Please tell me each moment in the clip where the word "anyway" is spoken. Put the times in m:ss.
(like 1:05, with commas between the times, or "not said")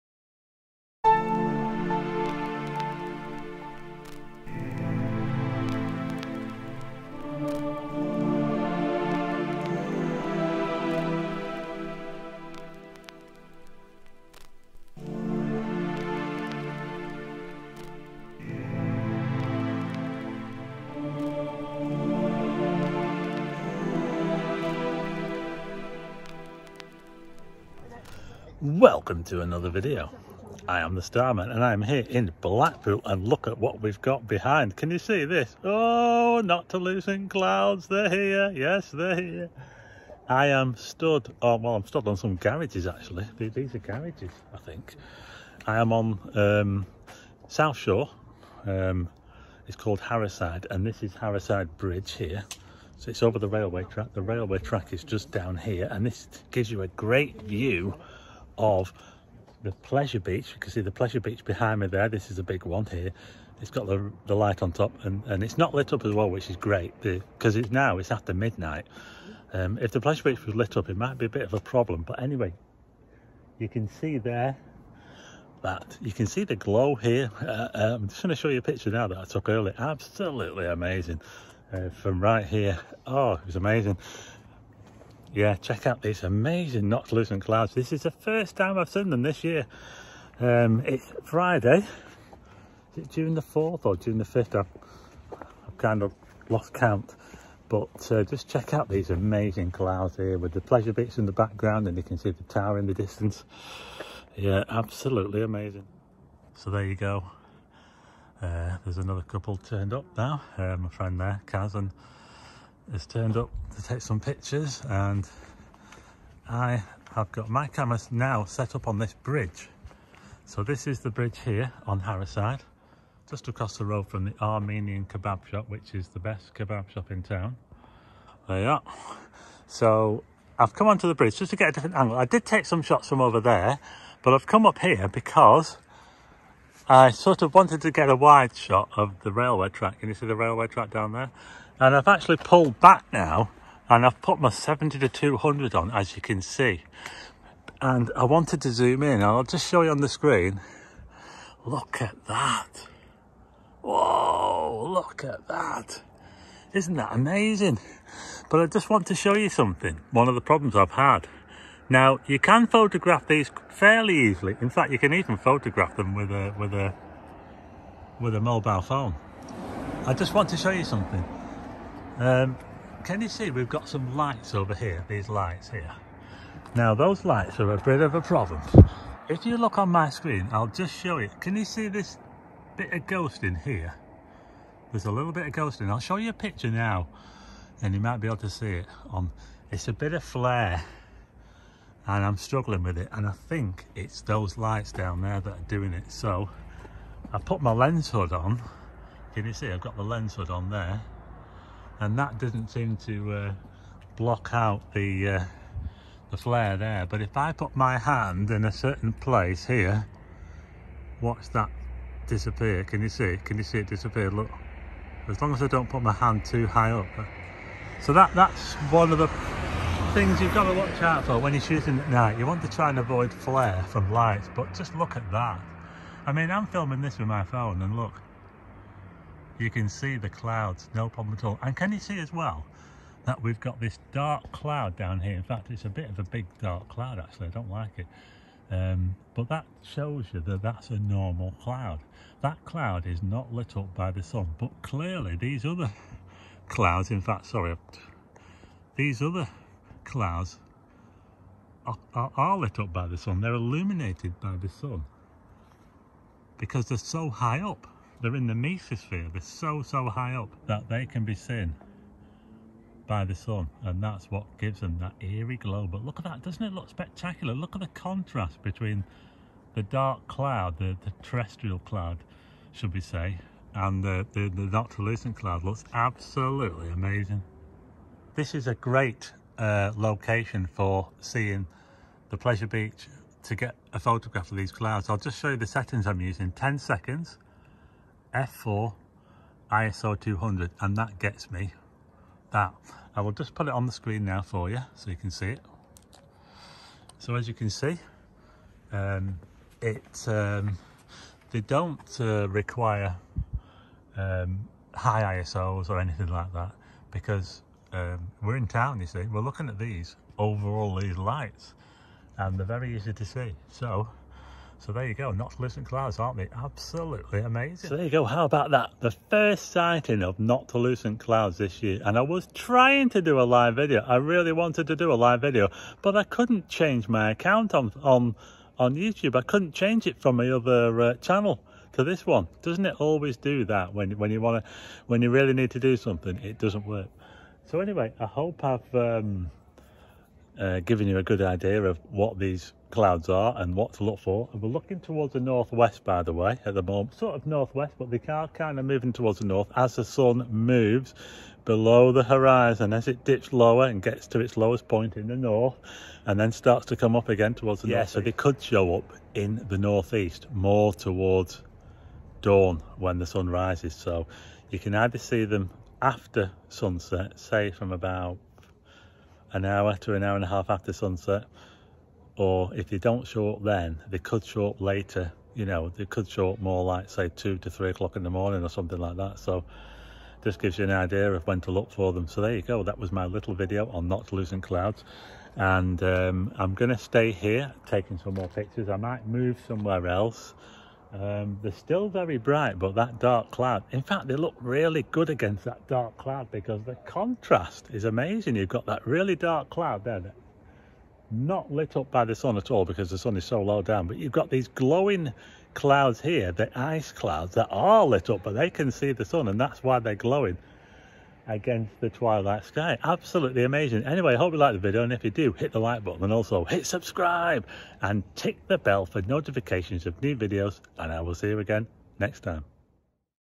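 1:12, 5:37, 6:54.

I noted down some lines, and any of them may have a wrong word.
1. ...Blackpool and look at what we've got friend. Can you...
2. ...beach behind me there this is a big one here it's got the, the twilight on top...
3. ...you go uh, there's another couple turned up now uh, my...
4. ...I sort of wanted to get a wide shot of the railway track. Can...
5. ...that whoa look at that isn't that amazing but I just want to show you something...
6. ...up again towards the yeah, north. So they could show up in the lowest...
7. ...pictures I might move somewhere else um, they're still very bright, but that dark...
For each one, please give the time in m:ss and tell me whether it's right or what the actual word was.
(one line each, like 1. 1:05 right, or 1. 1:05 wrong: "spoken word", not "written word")
1. 0:32 wrong: "behind", not "friend"
2. 1:01 wrong: "light", not "twilight"
3. 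1:46 right
4. 2:16 right
5. 2:32 right
6. 5:57 wrong: "northeast", not "lowest"
7. 6:28 right.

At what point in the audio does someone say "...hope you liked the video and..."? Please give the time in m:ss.
6:54.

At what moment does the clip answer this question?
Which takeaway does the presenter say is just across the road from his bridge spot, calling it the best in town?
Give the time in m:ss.
2:04.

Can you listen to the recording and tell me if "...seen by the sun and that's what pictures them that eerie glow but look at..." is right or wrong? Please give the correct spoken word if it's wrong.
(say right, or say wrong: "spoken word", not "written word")
wrong: "gives", not "pictures".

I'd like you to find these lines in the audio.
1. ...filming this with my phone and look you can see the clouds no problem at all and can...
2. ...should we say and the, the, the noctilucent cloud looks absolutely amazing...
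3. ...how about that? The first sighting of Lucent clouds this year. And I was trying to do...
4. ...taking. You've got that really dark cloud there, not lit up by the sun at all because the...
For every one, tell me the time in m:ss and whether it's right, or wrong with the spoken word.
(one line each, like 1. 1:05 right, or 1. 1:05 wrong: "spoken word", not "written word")
1. 3:46 right
2. 4:32 right
3. 5:18 right
4. 6:38 wrong: "amazing", not "taking".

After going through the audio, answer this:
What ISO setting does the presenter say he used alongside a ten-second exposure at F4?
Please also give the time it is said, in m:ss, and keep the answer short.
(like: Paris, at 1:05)
200, at 4:49.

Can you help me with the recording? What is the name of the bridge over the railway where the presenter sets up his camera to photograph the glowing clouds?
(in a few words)
Harrowside Bridge.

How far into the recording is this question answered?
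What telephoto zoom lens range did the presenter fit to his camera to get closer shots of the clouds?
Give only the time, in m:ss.
2:24.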